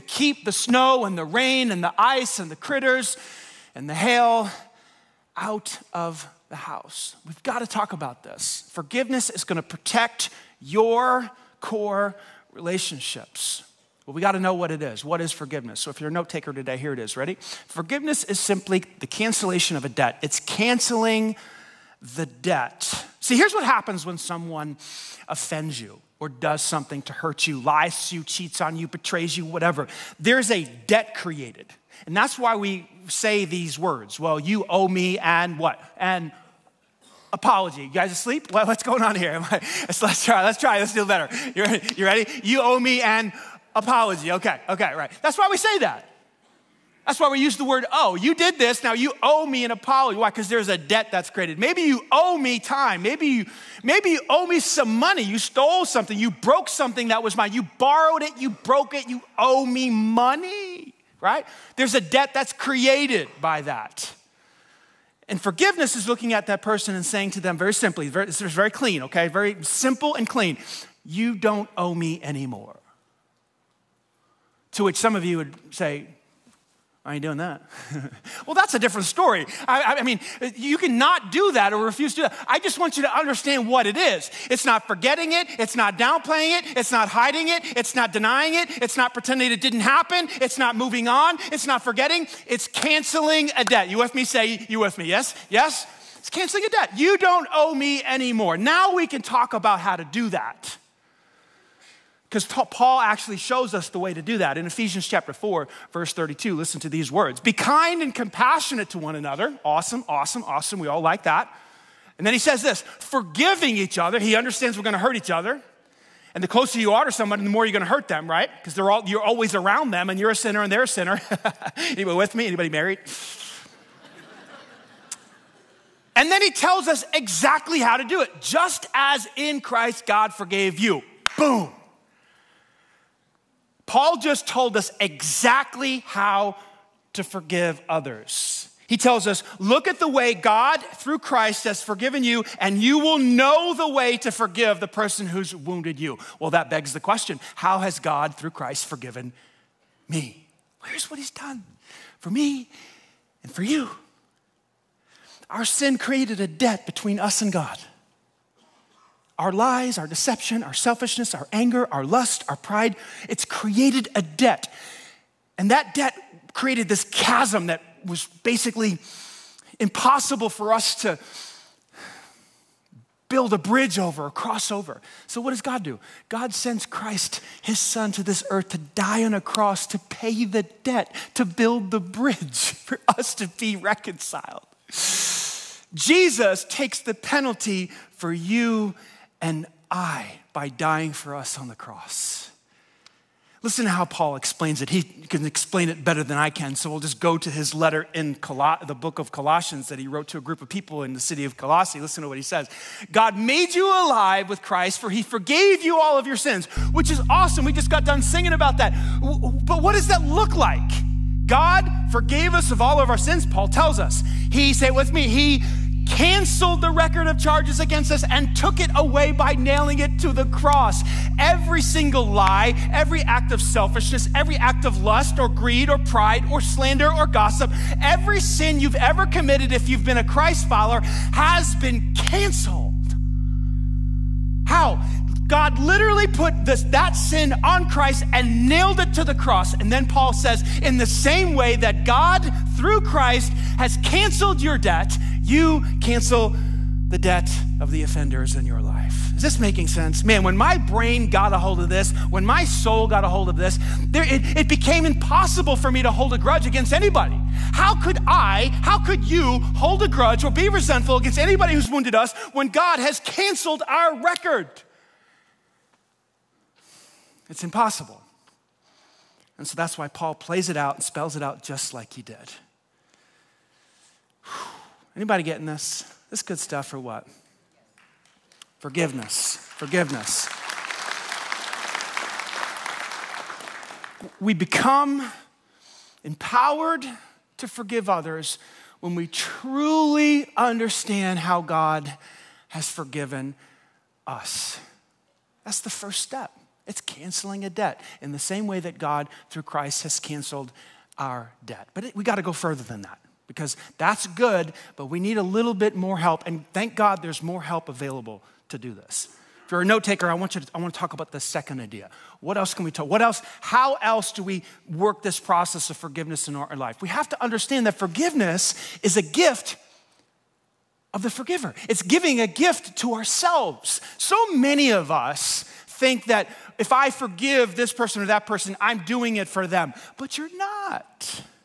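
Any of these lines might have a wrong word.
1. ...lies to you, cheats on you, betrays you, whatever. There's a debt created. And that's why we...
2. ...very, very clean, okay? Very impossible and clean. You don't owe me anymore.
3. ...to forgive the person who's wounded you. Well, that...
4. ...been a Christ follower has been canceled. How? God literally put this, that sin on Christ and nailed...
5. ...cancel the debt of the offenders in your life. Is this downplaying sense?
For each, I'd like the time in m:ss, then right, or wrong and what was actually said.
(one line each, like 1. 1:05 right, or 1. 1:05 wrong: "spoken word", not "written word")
1. 0:27 right
2. 1:08 wrong: "simple", not "impossible"
3. 2:24 right
4. 3:50 right
5. 4:05 wrong: "making", not "downplaying".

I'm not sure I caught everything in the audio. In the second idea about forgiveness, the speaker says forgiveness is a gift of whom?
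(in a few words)
the forgiver.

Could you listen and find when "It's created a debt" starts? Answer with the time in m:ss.
2:43.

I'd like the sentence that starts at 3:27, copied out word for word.
We just got done singing about that.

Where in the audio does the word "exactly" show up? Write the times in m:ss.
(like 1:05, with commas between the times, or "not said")
2:07, 2:14.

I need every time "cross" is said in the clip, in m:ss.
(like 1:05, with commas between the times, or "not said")
2:54, 2:59, 3:11, 3:40, 3:59.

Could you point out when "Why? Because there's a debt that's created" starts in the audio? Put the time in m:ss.
0:50.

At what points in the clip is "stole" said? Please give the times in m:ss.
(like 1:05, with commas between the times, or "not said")
0:55.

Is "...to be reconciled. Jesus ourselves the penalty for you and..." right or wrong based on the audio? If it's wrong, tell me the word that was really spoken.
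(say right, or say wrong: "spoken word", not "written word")
wrong: "takes", not "ourselves".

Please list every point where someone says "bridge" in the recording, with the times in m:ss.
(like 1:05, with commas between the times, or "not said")
2:53, 3:01.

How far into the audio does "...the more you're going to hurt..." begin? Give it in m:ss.
1:57.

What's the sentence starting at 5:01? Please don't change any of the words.
But it, we got to go further than that because that's good, but we need a little bit more help.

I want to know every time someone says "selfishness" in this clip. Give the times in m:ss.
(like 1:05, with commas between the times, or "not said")
2:40, 3:43.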